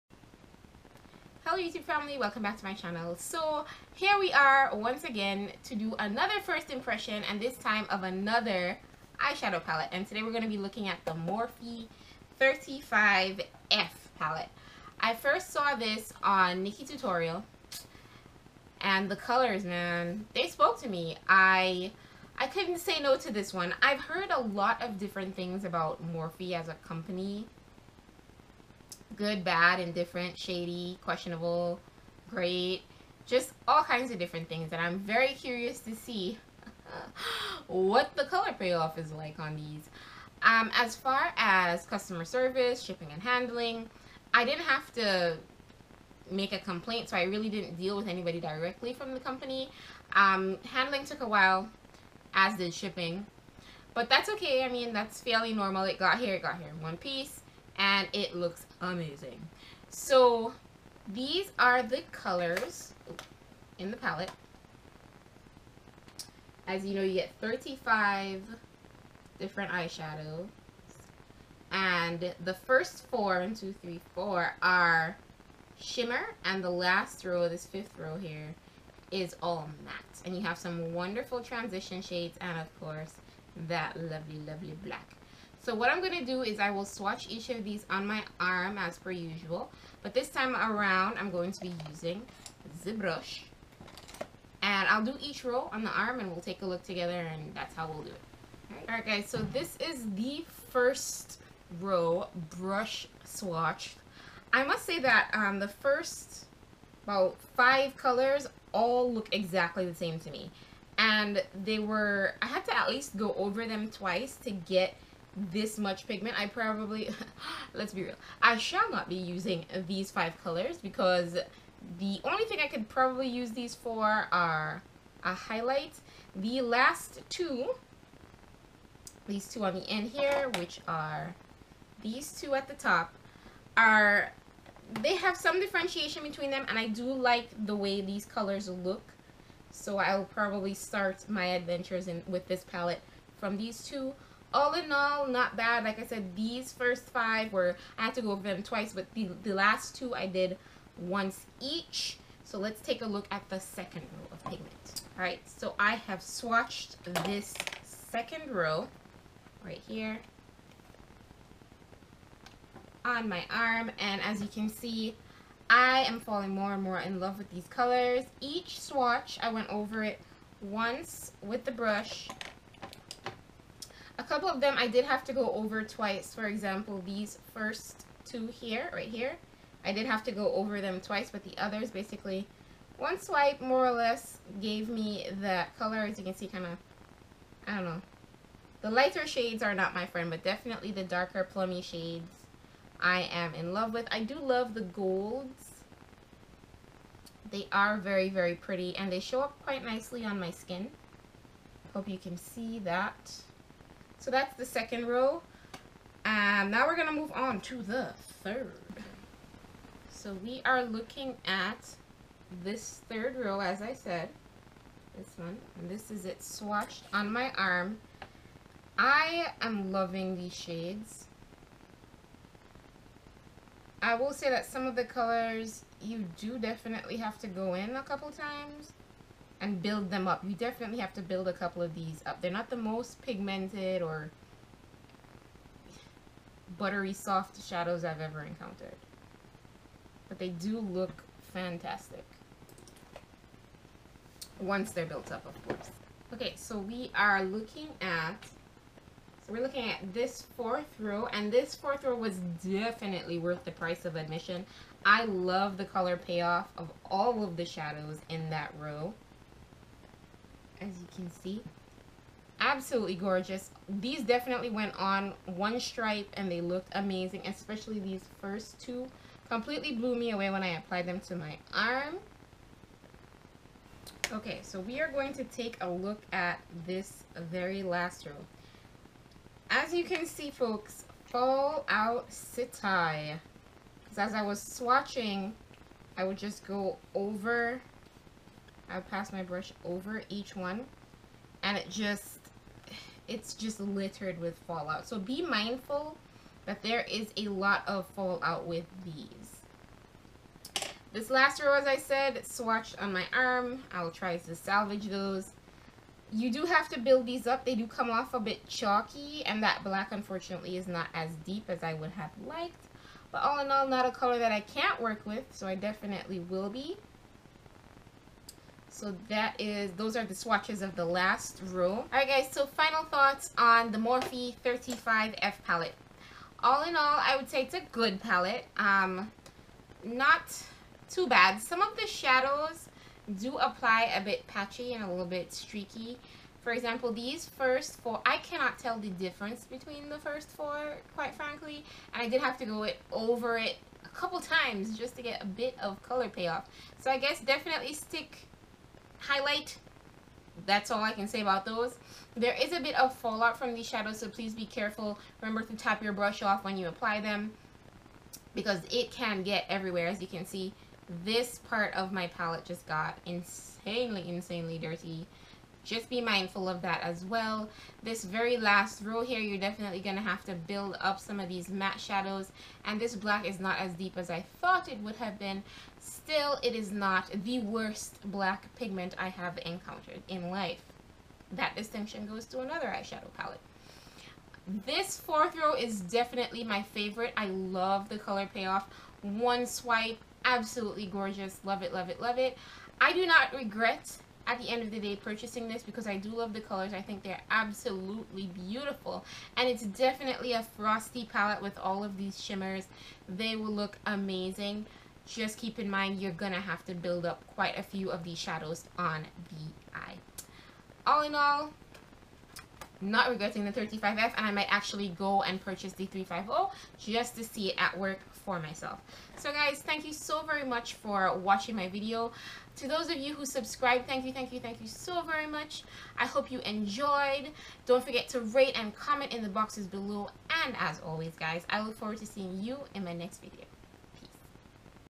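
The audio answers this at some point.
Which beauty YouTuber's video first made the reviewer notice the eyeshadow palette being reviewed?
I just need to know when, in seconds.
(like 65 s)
16 s.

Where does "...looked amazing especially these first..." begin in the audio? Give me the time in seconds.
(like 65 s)
266 s.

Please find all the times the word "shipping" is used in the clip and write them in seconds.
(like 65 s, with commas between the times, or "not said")
42 s, 52 s.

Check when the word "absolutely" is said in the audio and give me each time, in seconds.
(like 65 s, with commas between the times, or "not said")
262 s, 390 s, 397 s.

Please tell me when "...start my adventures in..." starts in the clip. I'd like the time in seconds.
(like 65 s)
140 s.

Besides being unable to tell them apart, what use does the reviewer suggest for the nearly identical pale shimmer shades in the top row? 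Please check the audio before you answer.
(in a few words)
a highlight.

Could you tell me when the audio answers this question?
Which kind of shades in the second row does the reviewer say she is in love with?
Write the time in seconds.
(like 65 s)
191 s.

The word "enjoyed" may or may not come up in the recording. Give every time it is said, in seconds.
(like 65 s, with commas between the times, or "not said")
426 s.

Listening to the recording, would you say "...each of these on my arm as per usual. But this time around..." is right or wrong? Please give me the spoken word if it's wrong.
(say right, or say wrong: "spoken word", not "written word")
right.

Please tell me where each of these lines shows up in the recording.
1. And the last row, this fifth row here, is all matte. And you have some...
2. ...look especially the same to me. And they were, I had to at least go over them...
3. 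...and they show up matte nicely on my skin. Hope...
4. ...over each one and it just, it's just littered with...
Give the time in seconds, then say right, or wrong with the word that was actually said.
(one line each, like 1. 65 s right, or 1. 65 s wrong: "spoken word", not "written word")
1. 76 s right
2. 109 s wrong: "exactly", not "especially"
3. 198 s wrong: "quite", not "matte"
4. 289 s right.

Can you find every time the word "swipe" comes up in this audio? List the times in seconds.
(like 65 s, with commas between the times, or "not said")
183 s, 389 s.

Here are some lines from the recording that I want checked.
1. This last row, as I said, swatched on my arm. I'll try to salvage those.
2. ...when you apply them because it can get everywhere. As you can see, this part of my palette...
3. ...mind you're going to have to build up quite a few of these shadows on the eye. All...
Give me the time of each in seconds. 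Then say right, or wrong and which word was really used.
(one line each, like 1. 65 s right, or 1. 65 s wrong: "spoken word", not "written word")
1. 301 s right
2. 356 s right
3. 405 s right.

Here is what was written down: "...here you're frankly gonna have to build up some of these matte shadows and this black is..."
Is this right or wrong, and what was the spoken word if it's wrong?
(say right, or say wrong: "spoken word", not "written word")
wrong: "definitely", not "frankly".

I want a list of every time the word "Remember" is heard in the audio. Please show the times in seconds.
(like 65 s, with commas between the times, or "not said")
355 s.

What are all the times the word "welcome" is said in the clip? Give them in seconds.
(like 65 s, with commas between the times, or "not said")
2 s.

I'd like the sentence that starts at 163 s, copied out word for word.
And as you can see, I am falling more and more in love with these colors.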